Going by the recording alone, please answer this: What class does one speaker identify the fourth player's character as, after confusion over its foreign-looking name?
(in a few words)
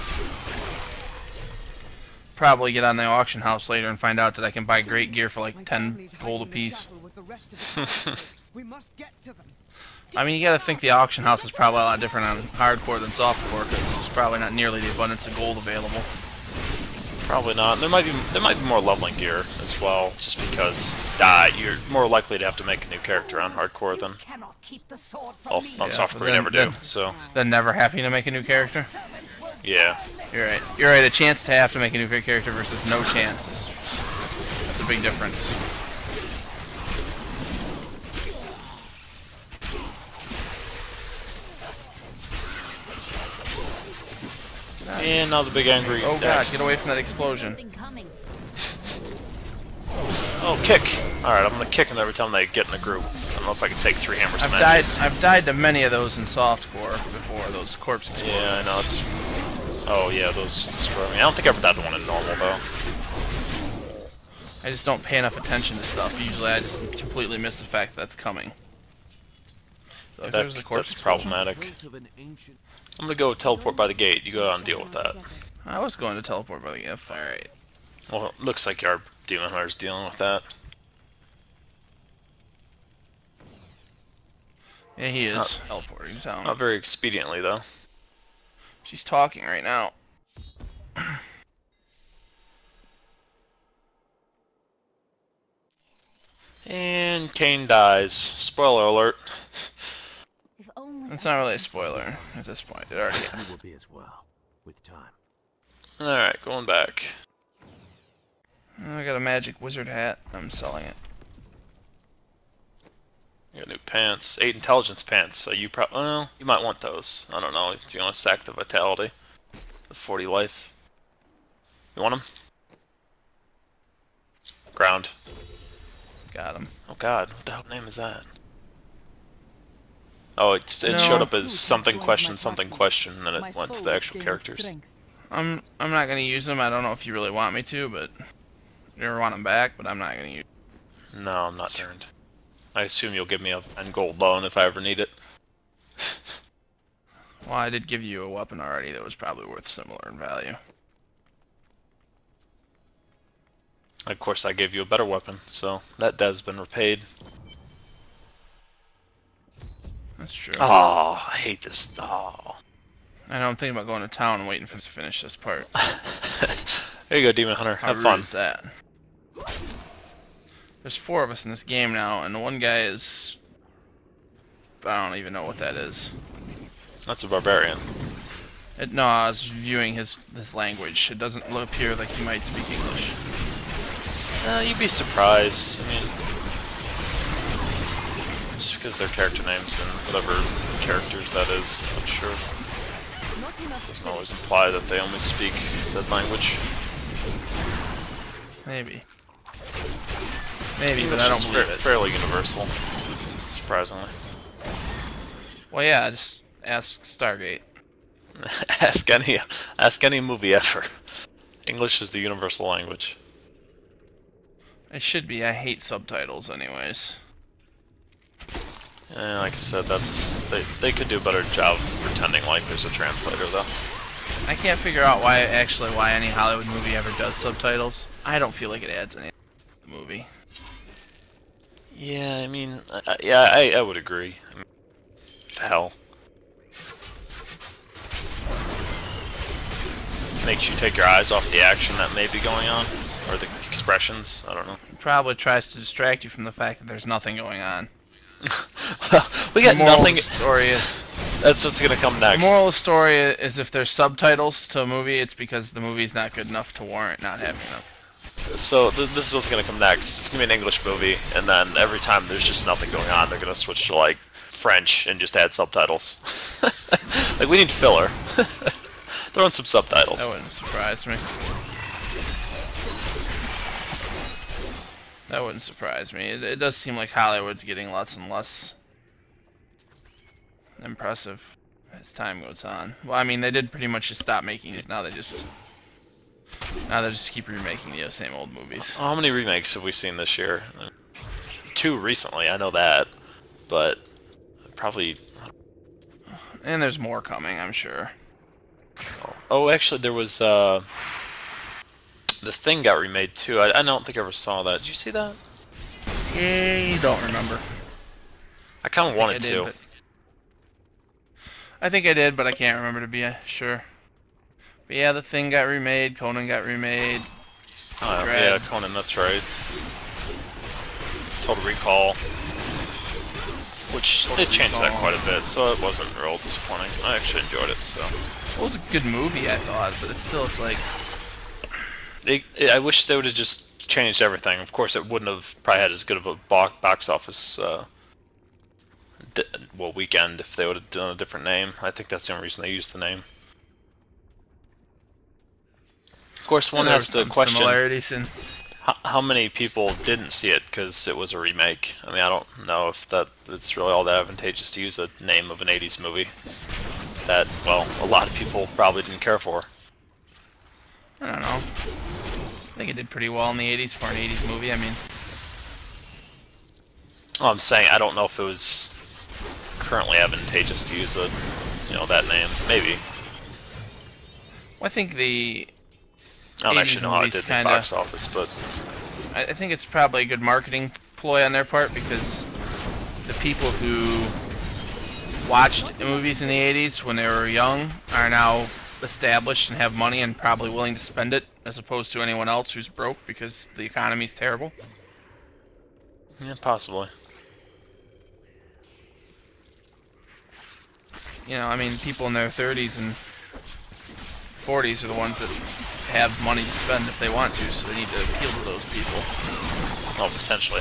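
Barbarian.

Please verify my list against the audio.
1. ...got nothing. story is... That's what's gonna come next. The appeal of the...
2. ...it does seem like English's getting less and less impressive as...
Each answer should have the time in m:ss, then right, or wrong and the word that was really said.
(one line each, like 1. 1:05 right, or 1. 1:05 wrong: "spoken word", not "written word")
1. 4:09 wrong: "moral", not "appeal"
2. 4:36 wrong: "Hollywood", not "English".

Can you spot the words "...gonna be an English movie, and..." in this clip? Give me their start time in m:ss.
4:20.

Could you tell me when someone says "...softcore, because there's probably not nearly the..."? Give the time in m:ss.
0:13.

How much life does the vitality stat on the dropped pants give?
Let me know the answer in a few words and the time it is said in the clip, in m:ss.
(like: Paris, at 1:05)
40, at 1:59.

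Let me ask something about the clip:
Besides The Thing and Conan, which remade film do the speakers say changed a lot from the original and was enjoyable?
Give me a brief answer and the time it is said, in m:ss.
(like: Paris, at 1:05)
Total Recall, at 5:21.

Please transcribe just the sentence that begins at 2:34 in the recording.
Of course, I gave you a better weapon, so that debt's been repaid.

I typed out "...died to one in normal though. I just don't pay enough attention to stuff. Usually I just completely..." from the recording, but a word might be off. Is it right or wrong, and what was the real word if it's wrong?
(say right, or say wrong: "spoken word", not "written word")
right.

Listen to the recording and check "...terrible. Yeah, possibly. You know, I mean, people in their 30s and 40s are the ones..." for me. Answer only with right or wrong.
right.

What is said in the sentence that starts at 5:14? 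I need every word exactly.
But yeah, the thing got remade, Conan got remade.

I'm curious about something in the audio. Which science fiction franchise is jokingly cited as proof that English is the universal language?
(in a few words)
Stargate.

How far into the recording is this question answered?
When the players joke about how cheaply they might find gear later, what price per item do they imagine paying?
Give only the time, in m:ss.
0:05.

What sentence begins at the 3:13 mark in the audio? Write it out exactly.
Doesn't always imply that they only speak said language.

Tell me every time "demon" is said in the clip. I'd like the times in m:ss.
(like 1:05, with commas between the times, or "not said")
1:19, 2:47.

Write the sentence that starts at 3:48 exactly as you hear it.
I don't feel like it adds anything to the movie.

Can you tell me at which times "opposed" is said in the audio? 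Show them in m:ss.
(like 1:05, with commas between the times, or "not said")
6:31.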